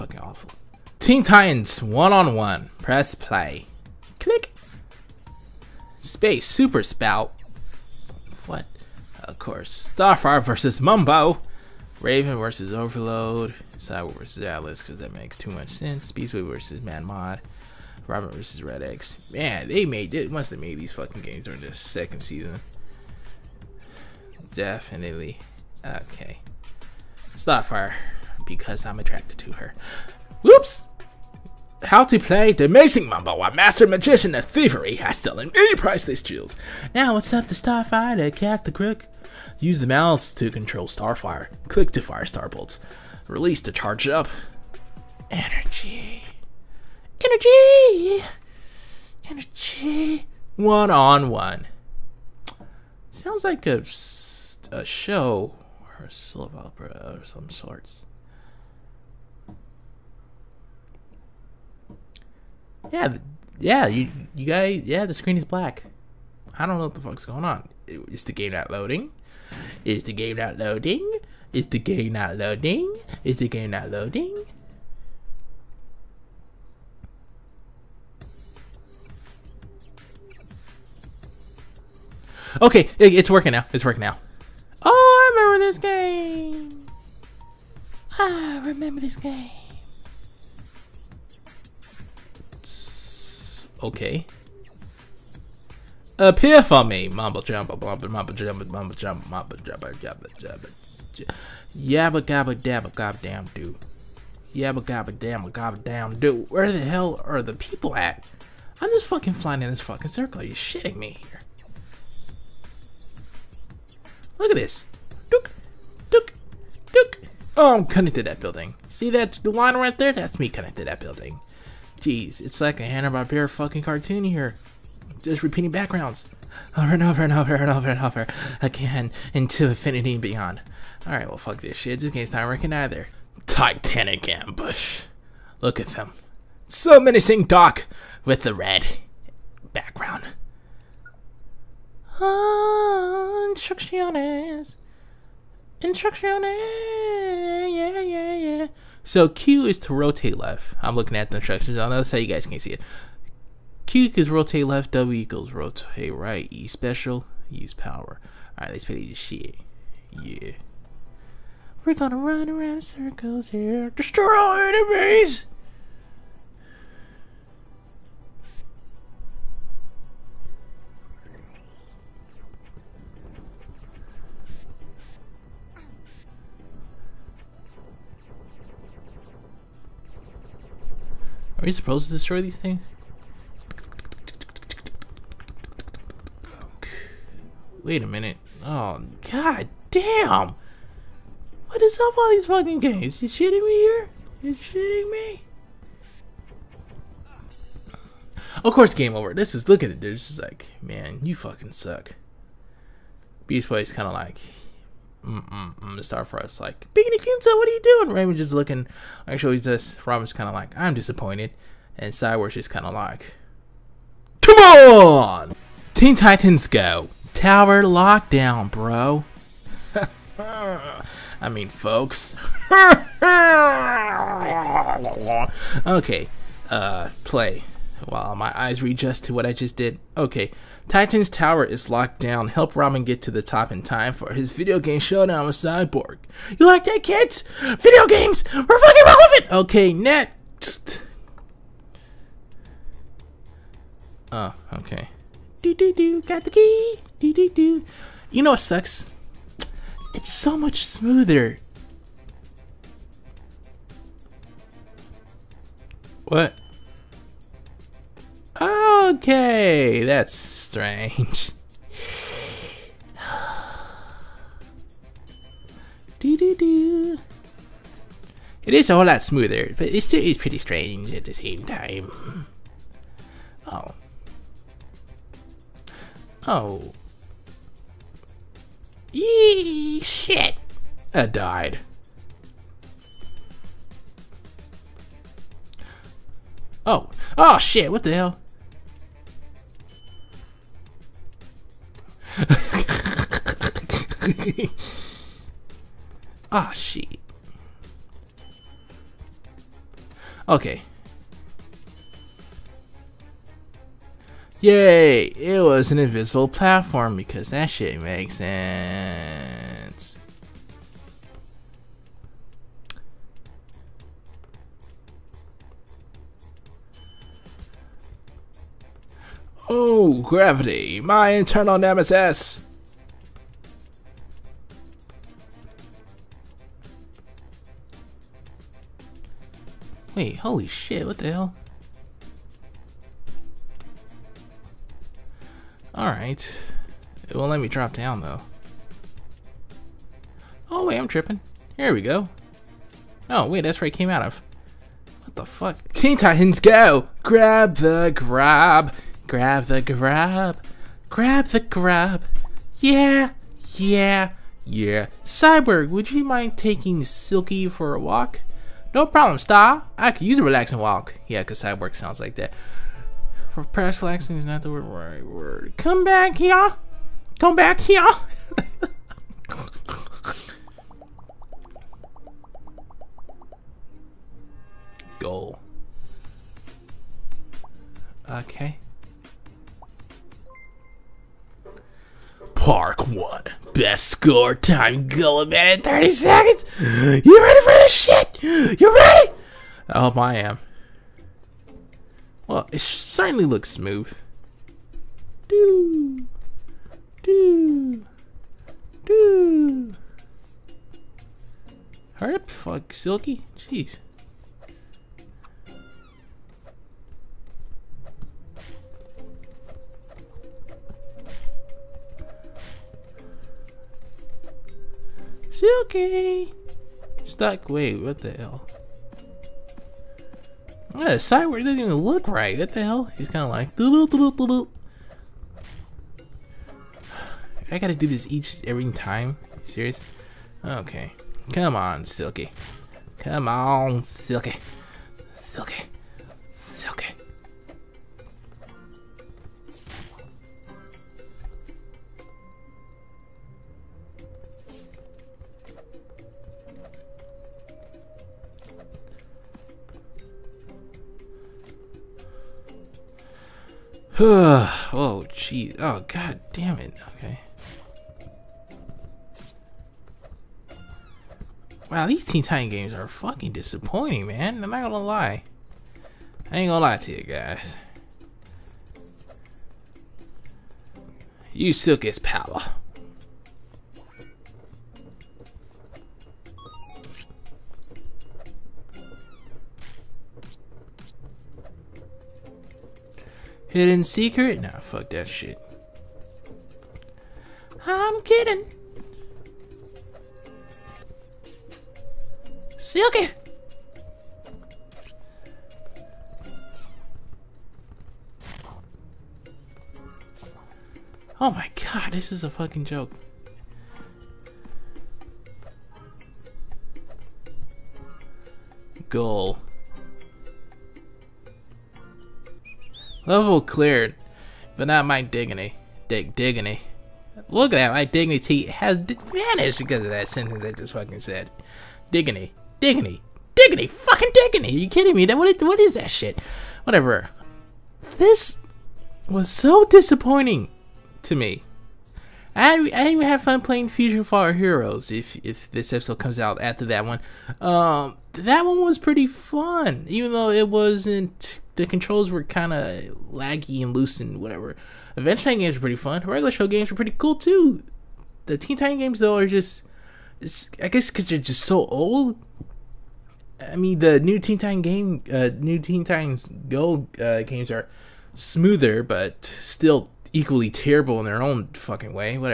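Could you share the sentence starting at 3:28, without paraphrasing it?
Raven just looking, actually just, Robin's kind of like, I'm disappointed.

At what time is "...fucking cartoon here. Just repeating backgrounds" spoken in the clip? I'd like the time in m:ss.
2:03.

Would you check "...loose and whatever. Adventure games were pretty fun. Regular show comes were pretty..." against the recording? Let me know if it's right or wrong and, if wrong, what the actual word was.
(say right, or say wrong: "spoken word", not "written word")
wrong: "games", not "comes".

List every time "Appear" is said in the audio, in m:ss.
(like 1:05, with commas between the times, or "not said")
1:36.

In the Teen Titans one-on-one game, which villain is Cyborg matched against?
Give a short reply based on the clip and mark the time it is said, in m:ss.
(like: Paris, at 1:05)
Atlas, at 0:14.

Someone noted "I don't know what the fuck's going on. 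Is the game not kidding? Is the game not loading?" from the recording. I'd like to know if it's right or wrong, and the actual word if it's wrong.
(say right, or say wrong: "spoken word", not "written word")
wrong: "loading", not "kidding".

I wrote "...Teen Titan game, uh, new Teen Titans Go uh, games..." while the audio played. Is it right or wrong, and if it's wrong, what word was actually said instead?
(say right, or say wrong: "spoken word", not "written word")
right.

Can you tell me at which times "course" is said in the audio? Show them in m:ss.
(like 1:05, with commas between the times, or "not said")
0:09, 3:18.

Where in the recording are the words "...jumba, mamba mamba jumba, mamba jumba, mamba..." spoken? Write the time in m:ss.
1:37.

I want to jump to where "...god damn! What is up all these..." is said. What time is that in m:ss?
3:09.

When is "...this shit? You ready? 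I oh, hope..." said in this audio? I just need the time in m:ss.
6:27.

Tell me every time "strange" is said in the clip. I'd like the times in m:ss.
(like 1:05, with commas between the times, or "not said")
4:20, 4:30.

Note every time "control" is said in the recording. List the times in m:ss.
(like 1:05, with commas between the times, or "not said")
0:40, 9:01.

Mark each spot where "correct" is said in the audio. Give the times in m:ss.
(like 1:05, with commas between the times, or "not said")
not said.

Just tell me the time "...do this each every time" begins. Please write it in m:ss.
7:07.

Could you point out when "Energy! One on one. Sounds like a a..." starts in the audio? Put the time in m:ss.
0:49.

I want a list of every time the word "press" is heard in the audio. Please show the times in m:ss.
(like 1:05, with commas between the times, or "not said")
0:02, 6:03.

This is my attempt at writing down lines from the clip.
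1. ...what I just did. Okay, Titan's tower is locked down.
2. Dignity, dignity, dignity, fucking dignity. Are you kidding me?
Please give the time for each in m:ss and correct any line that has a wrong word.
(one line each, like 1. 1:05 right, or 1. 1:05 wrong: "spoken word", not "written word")
1. 3:49 right
2. 8:42 right.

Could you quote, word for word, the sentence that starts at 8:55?
If if this episode comes out after that one, um, that one was pretty fun.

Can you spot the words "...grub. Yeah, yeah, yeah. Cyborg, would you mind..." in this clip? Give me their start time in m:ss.
5:51.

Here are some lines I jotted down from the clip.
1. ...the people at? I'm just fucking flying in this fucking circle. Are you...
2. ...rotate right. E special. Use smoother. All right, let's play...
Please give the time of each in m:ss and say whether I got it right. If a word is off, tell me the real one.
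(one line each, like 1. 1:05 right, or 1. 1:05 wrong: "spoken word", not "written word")
1. 1:47 right
2. 2:35 wrong: "power", not "smoother".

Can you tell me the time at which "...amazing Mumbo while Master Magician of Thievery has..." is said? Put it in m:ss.
0:32.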